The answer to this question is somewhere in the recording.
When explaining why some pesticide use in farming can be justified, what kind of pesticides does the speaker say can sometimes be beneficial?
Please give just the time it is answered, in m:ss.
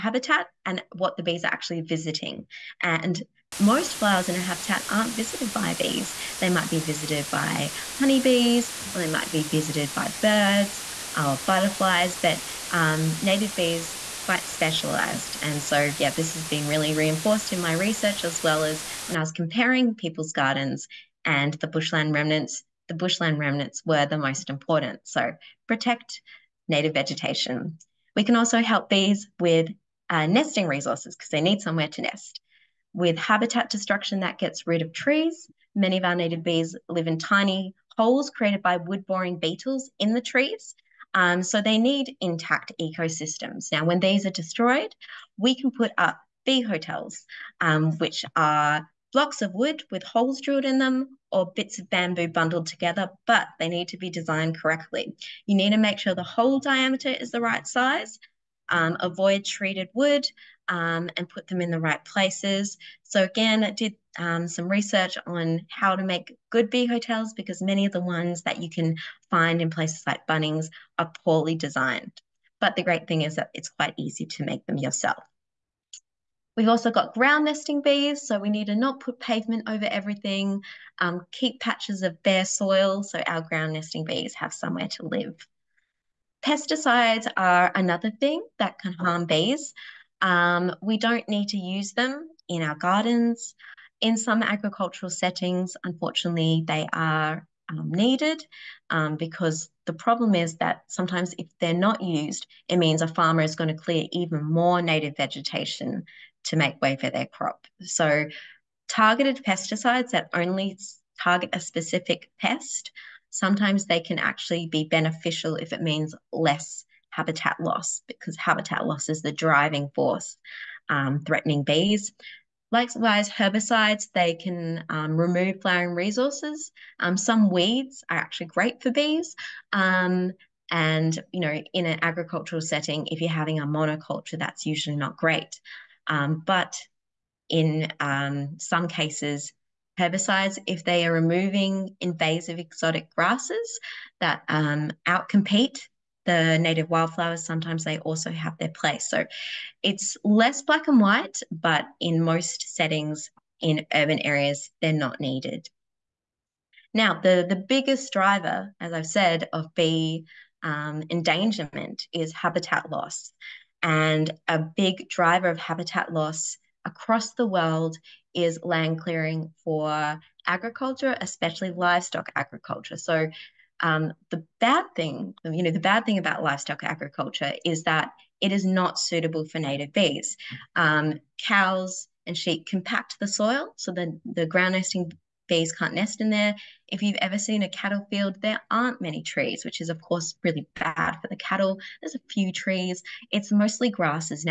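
1:48.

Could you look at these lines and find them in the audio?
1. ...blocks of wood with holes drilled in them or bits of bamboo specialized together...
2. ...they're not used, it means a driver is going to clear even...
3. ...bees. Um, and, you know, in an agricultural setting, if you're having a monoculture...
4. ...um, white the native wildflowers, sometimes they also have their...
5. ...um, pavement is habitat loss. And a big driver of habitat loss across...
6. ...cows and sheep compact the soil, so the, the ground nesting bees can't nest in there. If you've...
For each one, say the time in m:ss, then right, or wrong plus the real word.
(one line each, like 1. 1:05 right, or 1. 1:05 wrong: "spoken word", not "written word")
1. 0:49 wrong: "bundled", not "specialized"
2. 1:41 wrong: "farmer", not "driver"
3. 2:08 right
4. 2:24 wrong: "outcompete", not "white"
5. 2:40 wrong: "endangerment", not "pavement"
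6. 3:01 right.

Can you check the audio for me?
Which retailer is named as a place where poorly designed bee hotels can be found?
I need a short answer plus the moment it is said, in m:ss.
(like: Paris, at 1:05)
Bunnings, at 1:10.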